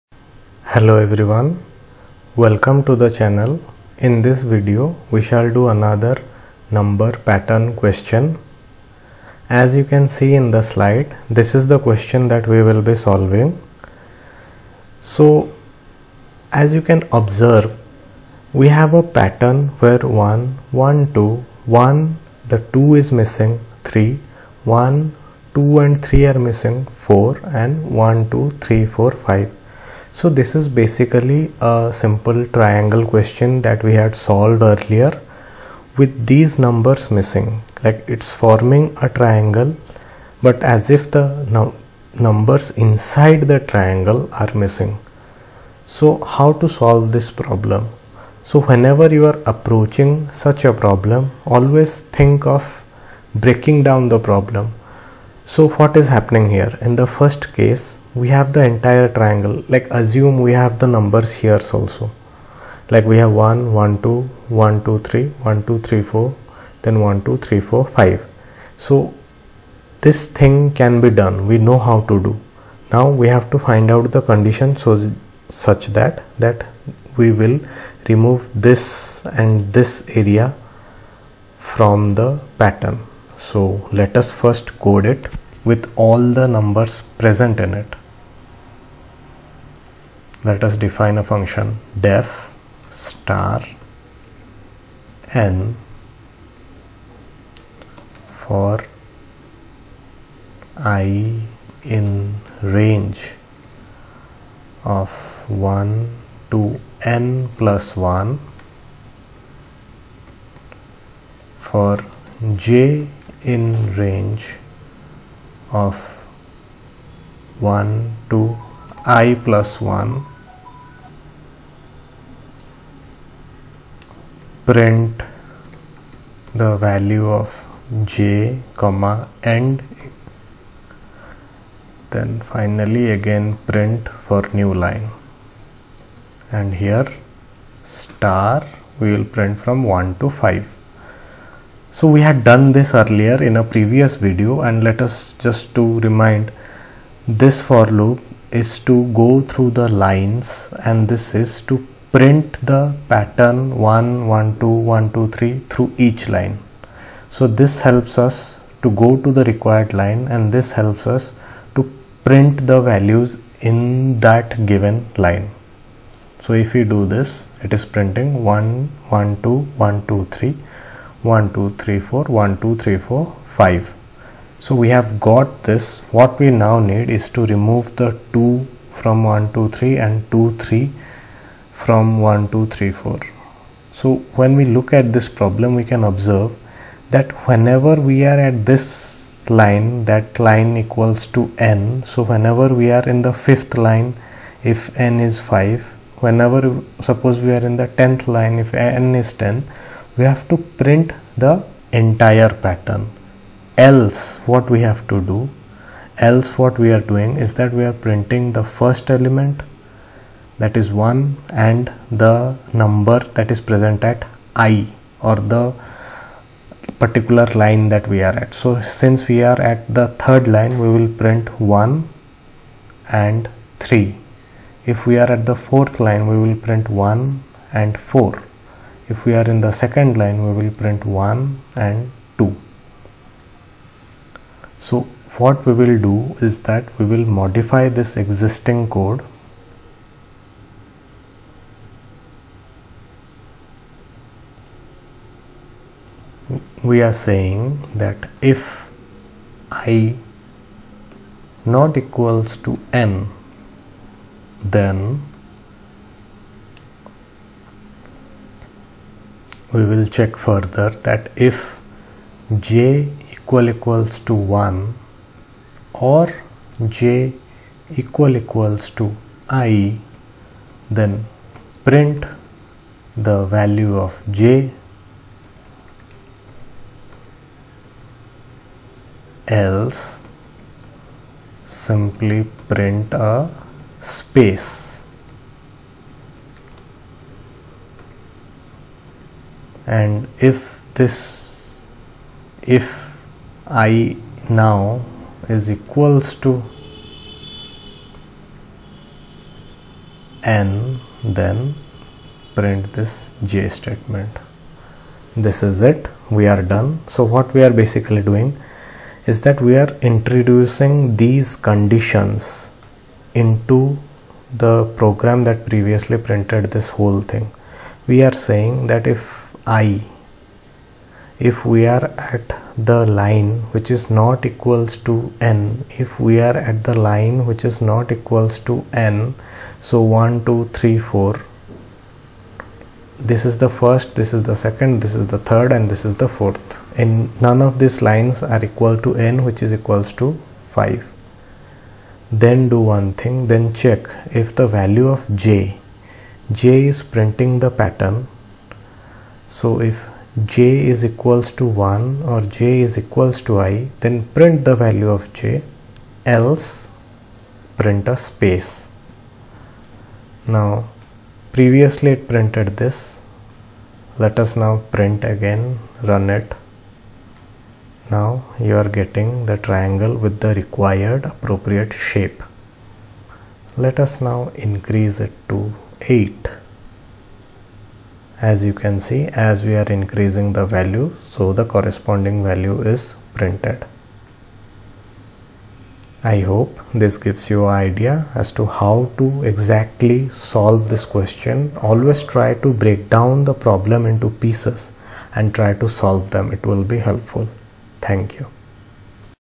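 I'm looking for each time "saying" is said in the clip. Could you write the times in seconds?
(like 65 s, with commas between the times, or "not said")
247 s, 318 s.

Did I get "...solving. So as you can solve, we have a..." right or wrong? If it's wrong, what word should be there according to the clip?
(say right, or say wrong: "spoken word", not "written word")
wrong: "observe", not "solve".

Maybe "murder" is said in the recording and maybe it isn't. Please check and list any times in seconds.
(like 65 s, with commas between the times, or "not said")
not said.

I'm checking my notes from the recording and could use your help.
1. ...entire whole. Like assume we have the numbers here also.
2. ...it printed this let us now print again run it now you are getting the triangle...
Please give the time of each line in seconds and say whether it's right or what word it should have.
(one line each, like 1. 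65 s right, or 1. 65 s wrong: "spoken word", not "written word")
1. 58 s wrong: "triangle", not "whole"
2. 362 s right.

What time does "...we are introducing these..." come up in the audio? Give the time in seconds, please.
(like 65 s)
309 s.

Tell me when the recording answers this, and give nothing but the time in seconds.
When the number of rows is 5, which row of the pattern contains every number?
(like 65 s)
193 s.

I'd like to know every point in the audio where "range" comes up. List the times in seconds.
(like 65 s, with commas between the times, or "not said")
102 s, 114 s.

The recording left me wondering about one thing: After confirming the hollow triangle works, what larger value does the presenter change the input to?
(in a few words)
8.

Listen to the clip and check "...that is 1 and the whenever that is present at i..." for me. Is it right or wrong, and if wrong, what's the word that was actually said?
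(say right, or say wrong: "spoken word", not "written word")
wrong: "number", not "whenever".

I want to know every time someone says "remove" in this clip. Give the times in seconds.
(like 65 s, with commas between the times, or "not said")
78 s, 177 s.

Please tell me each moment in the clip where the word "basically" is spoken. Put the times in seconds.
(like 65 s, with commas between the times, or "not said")
30 s, 307 s.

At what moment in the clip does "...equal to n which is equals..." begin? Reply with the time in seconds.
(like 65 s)
338 s.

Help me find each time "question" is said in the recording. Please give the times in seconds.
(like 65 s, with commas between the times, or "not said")
7 s, 11 s, 33 s, 391 s.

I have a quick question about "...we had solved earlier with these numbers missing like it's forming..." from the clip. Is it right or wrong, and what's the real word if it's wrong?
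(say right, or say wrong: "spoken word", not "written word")
right.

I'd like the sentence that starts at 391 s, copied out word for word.
Always try to break down the problem into pieces and try to solve them.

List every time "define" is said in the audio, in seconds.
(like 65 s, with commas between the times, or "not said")
90 s.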